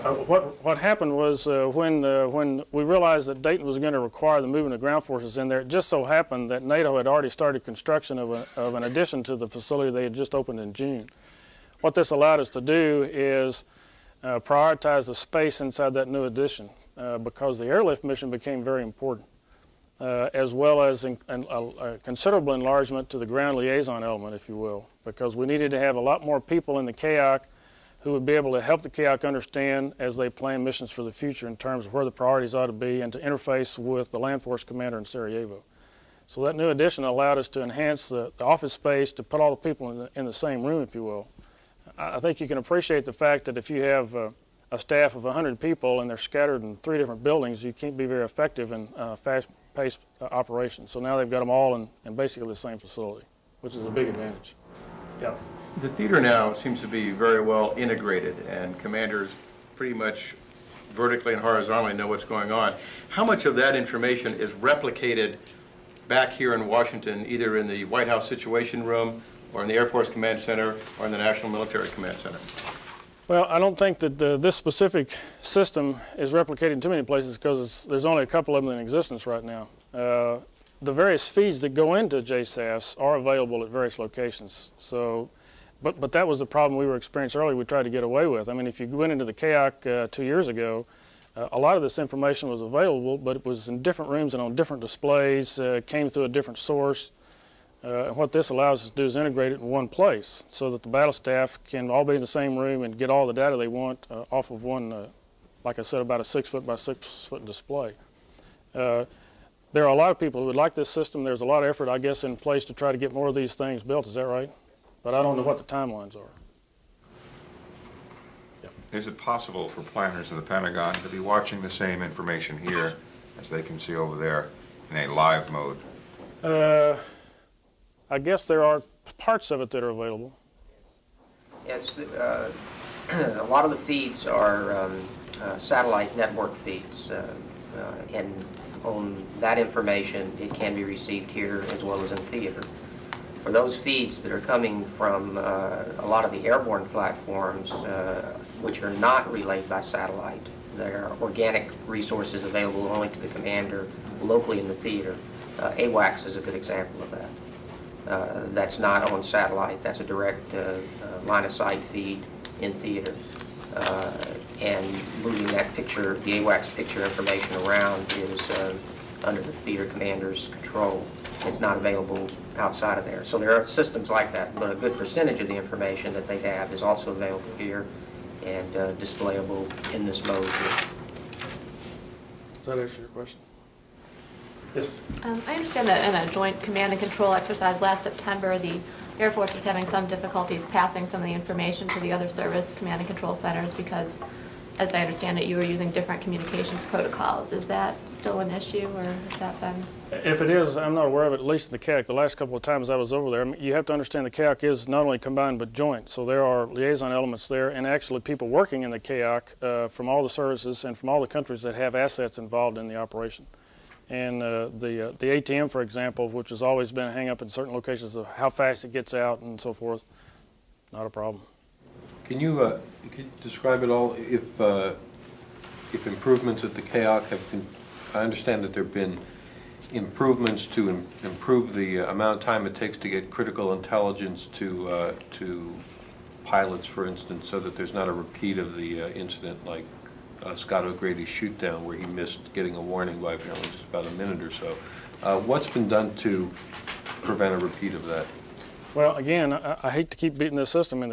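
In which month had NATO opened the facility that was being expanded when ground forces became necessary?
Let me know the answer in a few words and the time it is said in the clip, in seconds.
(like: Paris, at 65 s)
June, at 10 s.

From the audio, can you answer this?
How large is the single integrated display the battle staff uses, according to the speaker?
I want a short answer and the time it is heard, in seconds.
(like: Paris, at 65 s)
6 feet by 6 feet, at 106 s.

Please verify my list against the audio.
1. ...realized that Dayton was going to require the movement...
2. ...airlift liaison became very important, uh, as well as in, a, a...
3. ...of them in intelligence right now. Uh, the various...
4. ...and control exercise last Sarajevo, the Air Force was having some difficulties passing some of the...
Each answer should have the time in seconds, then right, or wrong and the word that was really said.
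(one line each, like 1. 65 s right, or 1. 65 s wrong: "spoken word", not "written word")
1. 2 s right
2. 17 s wrong: "mission", not "liaison"
3. 78 s wrong: "existence", not "intelligence"
4. 186 s wrong: "September", not "Sarajevo".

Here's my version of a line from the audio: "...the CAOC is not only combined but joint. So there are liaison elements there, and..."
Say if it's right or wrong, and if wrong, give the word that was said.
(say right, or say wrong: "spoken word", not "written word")
right.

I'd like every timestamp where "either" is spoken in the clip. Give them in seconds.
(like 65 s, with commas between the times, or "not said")
67 s.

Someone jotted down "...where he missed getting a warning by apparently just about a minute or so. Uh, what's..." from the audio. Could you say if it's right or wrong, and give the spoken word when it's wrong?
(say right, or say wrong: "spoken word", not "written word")
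right.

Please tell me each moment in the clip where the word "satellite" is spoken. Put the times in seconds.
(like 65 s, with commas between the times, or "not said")
135 s, 149 s, 159 s.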